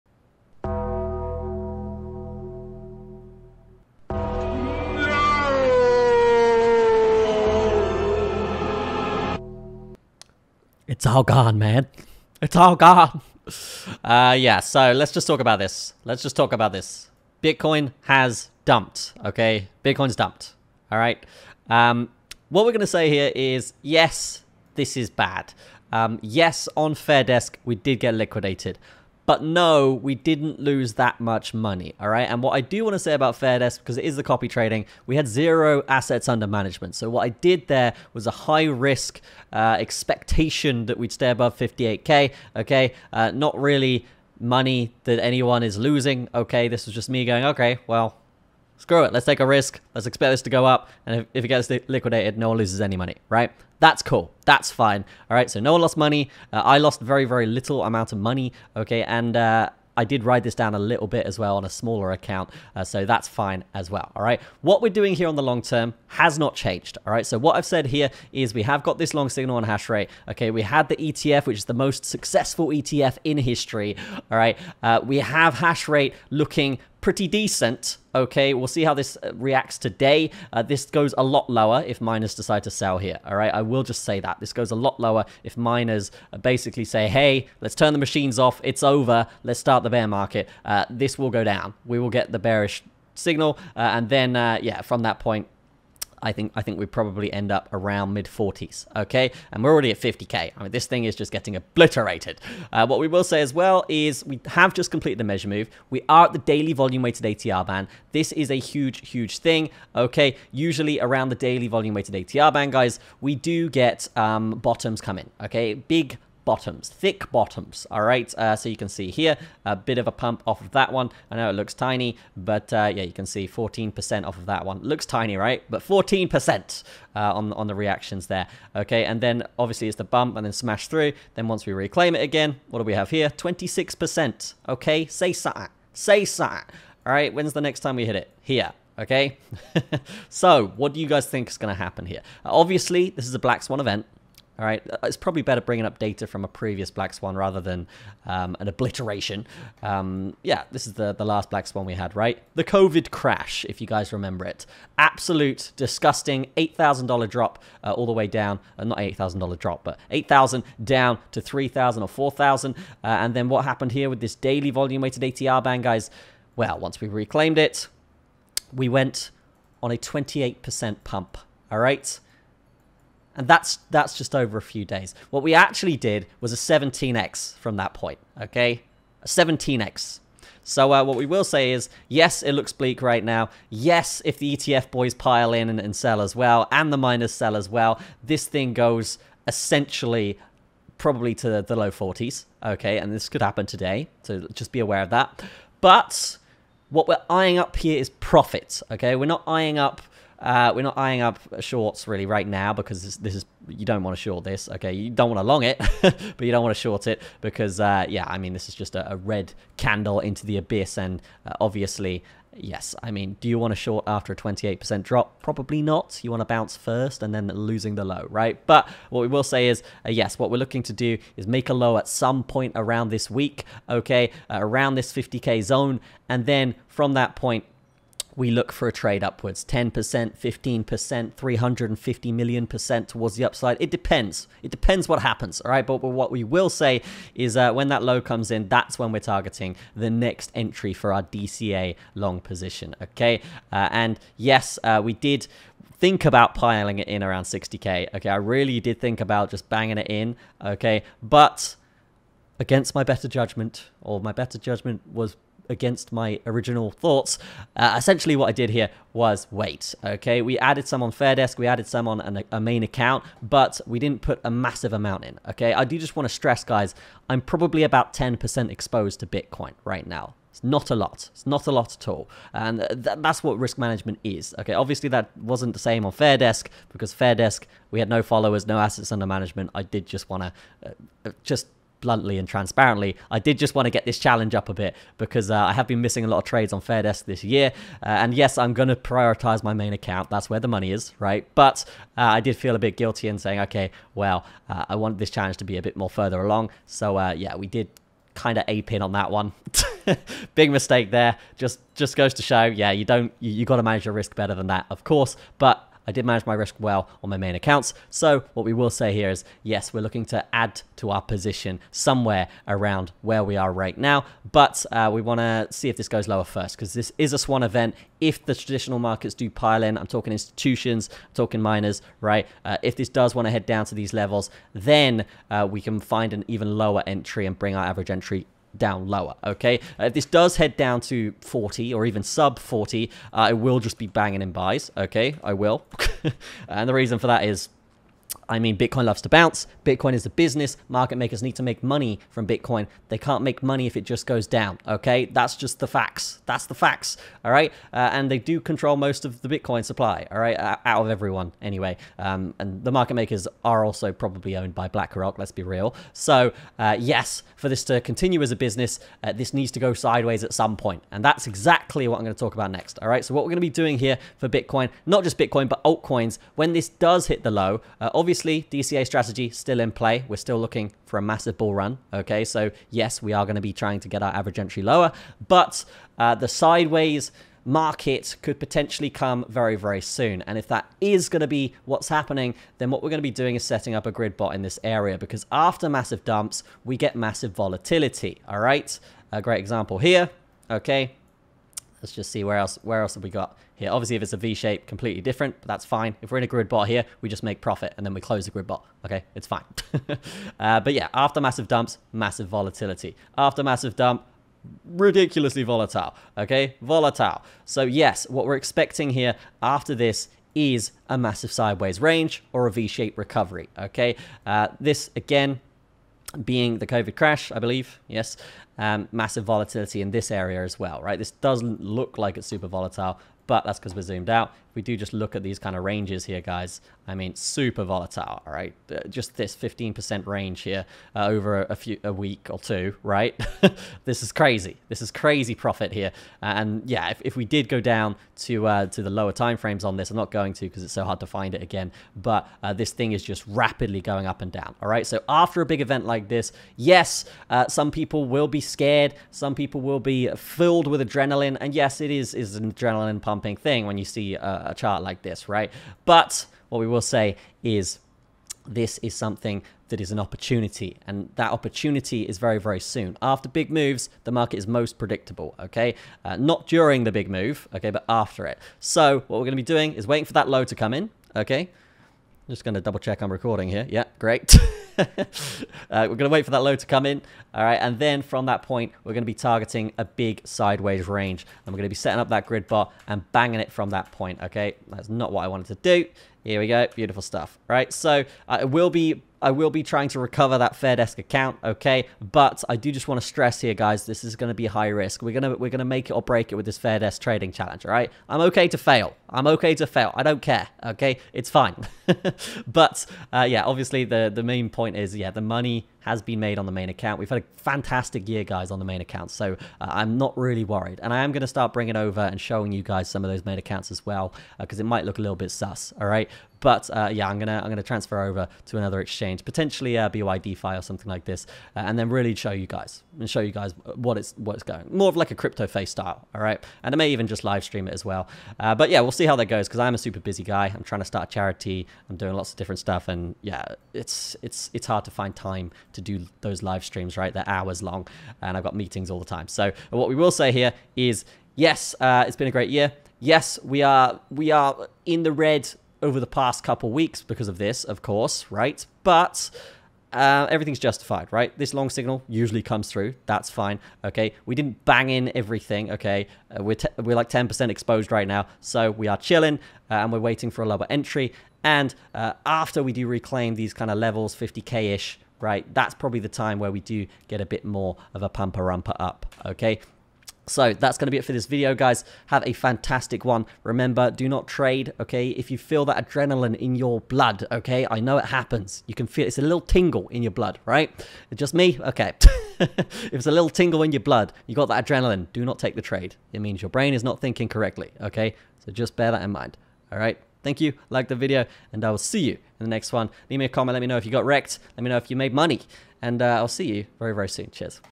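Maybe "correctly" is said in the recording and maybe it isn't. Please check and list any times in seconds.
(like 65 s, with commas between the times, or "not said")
587 s.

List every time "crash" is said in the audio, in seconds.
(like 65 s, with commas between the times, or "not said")
153 s, 417 s.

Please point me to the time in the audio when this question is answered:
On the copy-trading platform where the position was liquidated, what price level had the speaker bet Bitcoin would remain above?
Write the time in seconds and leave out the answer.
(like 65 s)
41 s.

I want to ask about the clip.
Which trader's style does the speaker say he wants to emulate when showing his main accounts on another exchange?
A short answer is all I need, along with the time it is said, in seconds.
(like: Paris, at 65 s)
CryptoFace, at 525 s.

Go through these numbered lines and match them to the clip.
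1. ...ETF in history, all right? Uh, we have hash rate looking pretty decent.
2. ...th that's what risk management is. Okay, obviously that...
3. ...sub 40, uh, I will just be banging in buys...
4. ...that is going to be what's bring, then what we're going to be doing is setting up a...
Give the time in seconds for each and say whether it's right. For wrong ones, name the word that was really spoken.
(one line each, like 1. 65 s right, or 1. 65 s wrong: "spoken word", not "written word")
1. 72 s right
2. 272 s right
3. 332 s right
4. 380 s wrong: "happening", not "bring".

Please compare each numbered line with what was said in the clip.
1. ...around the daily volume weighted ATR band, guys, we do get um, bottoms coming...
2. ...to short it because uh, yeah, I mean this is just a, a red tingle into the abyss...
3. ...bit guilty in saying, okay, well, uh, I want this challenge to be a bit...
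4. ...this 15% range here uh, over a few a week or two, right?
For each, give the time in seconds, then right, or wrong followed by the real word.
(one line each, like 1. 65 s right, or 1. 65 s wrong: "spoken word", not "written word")
1. 110 s right
2. 206 s wrong: "candle", not "tingle"
3. 292 s right
4. 429 s right.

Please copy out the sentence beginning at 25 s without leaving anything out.
Um, yes, on Fairdesk, we did get liquidated.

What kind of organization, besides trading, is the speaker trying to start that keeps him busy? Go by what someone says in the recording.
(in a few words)
A charity.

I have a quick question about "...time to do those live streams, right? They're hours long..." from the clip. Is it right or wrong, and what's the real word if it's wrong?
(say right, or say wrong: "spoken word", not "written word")
right.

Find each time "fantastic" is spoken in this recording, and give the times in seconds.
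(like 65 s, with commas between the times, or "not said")
507 s, 572 s.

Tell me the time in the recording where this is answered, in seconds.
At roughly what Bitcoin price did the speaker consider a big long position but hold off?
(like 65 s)
247 s.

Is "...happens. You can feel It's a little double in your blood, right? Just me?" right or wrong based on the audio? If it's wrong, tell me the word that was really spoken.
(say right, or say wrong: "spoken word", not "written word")
wrong: "tingle", not "double".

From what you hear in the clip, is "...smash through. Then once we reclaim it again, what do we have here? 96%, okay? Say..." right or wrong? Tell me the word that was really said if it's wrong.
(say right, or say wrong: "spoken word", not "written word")
wrong: "26", not "96".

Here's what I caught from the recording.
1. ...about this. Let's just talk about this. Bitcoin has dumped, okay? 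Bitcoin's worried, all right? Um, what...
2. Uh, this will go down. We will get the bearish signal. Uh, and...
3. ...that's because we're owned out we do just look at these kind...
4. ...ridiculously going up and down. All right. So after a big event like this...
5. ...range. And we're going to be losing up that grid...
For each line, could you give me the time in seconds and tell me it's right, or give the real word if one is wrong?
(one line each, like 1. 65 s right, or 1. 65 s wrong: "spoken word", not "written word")
1. 15 s wrong: "dumped", not "worried"
2. 90 s right
3. 423 s wrong: "zoomed", not "owned"
4. 443 s wrong: "rapidly", not "ridiculously"
5. 481 s wrong: "setting", not "losing".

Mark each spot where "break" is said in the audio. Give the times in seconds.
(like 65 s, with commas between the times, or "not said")
496 s.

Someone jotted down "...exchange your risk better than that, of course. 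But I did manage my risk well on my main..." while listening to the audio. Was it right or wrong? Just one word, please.
wrong.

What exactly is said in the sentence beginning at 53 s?
That's cool, that's fine, all right?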